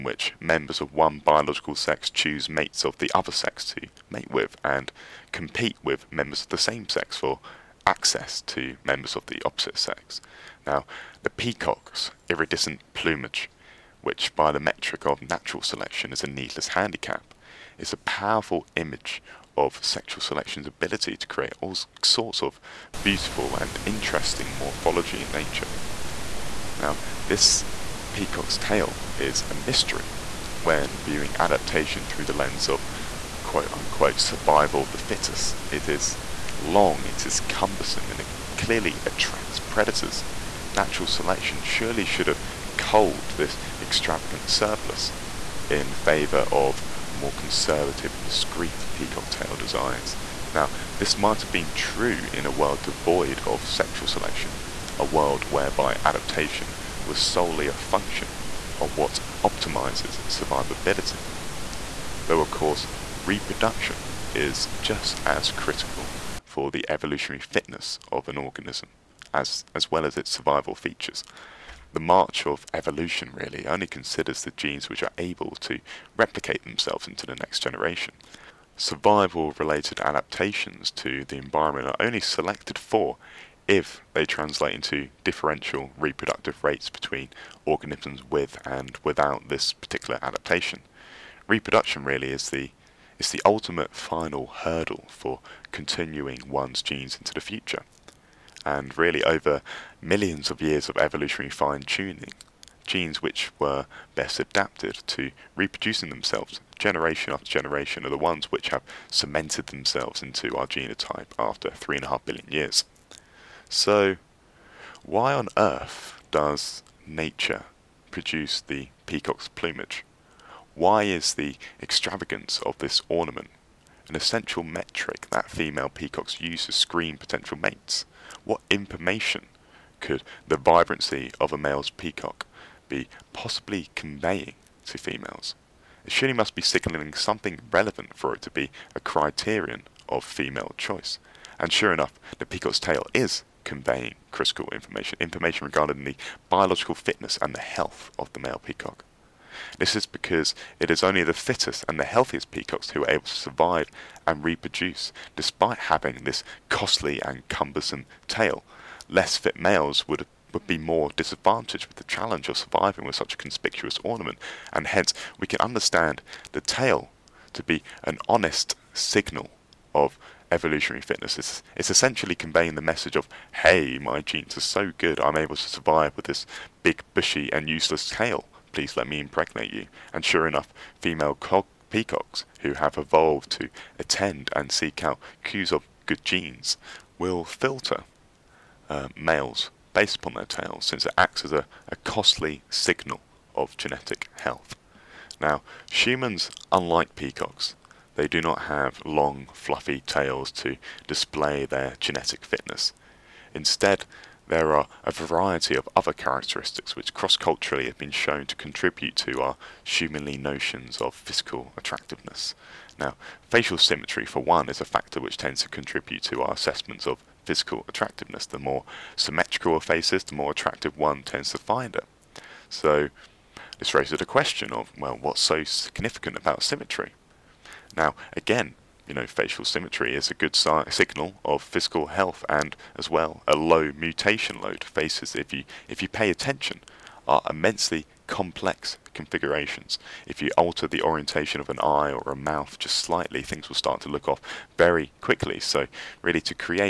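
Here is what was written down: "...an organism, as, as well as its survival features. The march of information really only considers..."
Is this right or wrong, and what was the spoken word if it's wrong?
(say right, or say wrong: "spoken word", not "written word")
wrong: "evolution", not "information".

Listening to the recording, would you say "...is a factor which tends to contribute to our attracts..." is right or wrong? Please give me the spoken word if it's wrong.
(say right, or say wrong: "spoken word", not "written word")
wrong: "assessments", not "attracts".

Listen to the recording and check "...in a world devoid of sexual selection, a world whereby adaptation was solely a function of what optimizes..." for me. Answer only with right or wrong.
right.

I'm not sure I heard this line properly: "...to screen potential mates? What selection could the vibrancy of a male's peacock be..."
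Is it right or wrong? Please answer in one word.
wrong.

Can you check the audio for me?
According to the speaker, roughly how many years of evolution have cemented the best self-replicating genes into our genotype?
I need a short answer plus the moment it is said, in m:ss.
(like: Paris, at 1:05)
3.5 billion years, at 1:51.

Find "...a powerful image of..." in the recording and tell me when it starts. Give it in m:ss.
0:17.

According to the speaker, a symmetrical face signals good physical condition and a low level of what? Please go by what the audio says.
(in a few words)
mutation load.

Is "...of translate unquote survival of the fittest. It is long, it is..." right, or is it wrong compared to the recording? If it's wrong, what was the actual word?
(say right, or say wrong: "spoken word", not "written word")
wrong: "quote", not "translate".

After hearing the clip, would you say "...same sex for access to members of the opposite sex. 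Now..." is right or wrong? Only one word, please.
right.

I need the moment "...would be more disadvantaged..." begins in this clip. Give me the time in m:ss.
2:40.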